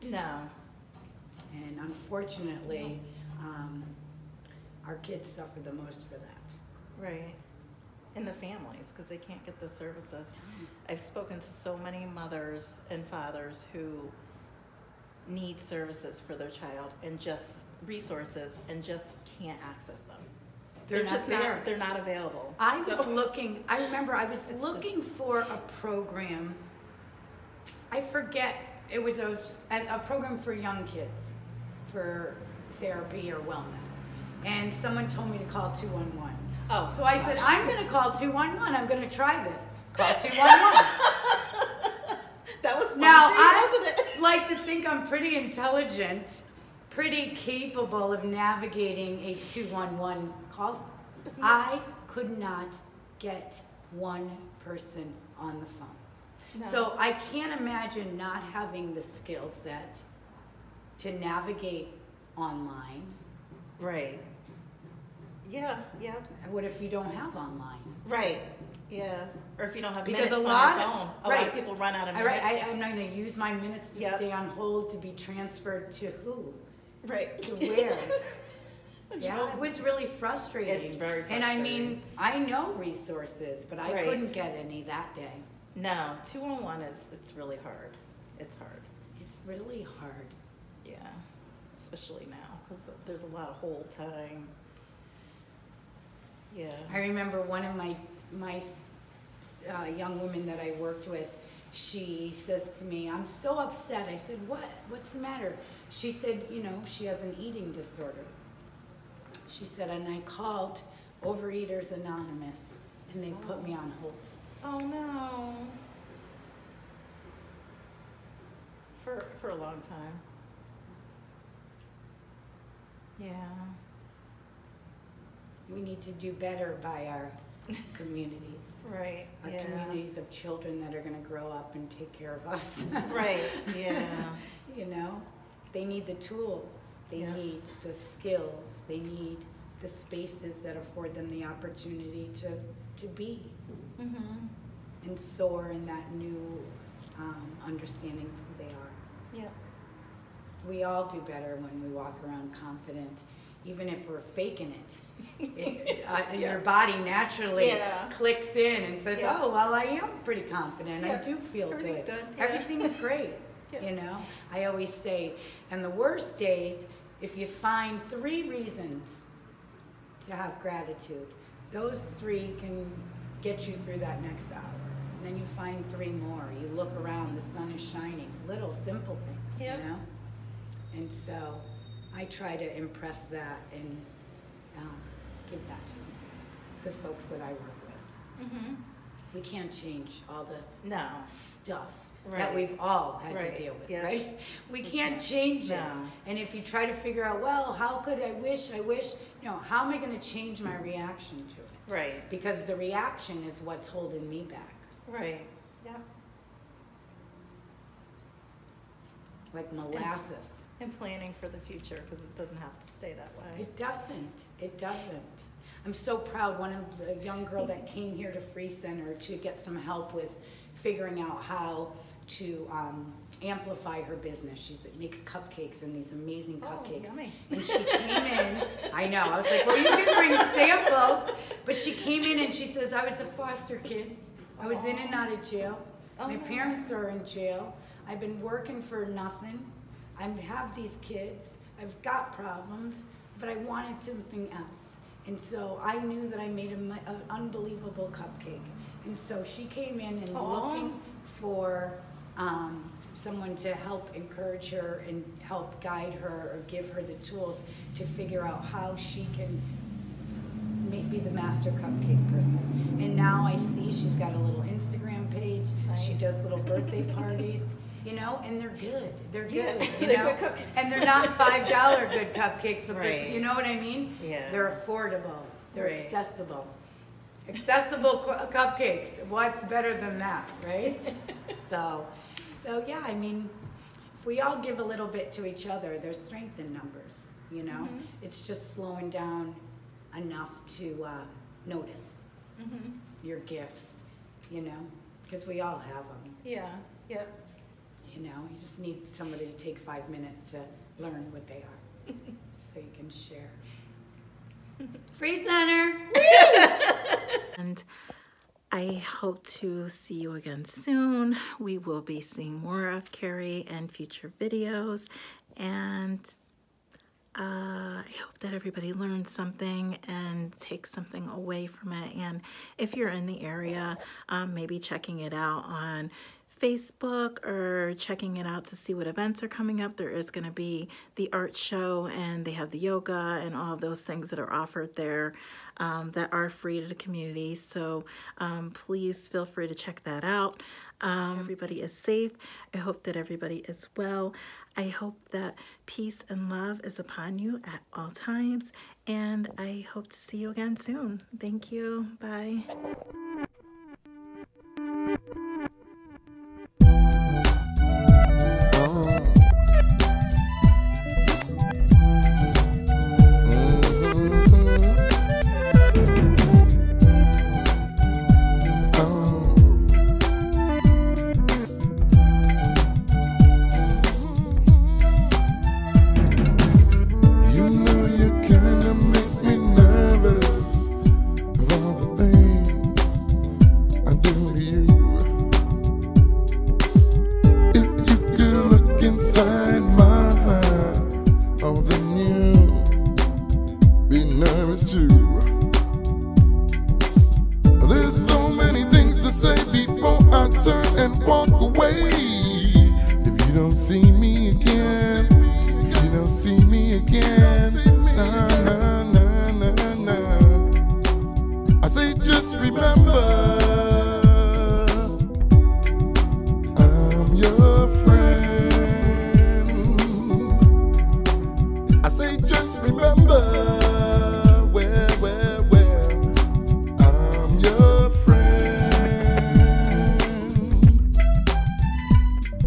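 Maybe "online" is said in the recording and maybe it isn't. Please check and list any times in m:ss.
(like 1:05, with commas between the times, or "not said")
1:02, 1:07.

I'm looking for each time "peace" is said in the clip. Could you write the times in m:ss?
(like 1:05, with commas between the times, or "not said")
5:45.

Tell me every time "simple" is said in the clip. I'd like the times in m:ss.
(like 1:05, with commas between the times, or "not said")
2:58.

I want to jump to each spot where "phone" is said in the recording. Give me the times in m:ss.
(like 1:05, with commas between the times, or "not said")
0:55, 1:10.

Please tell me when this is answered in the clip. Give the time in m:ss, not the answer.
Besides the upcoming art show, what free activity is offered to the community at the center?
5:32.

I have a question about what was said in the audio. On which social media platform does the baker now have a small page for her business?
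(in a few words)
Instagram.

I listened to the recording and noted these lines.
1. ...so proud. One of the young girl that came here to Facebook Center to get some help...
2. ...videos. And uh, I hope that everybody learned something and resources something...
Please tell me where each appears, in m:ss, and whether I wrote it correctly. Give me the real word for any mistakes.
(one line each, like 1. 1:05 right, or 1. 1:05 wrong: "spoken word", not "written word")
1. 3:35 wrong: "Free", not "Facebook"
2. 5:14 wrong: "takes", not "resources".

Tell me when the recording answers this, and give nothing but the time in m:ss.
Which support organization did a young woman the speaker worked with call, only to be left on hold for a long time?
1:51.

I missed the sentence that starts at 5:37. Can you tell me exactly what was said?
So um, please feel free to check that out.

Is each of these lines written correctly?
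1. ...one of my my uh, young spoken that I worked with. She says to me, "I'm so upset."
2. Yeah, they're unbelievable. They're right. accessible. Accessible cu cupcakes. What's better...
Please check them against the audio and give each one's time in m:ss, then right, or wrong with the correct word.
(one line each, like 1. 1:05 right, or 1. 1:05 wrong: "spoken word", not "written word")
1. 1:37 wrong: "women", not "spoken"
2. 4:34 wrong: "affordable", not "unbelievable".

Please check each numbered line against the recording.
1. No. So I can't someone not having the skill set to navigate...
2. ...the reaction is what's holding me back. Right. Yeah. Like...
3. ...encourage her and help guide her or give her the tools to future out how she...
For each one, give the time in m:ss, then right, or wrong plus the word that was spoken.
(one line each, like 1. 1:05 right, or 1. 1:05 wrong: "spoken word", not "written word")
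1. 0:56 wrong: "imagine", not "someone"
2. 3:22 right
3. 4:14 wrong: "figure", not "future".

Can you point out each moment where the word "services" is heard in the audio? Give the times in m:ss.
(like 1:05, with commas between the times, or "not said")
0:09, 0:15.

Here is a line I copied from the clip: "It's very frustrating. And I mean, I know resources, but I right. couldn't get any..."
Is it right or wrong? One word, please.
right.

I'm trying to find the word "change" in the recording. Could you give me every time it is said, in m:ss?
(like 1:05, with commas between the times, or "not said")
3:09, 3:15, 3:20.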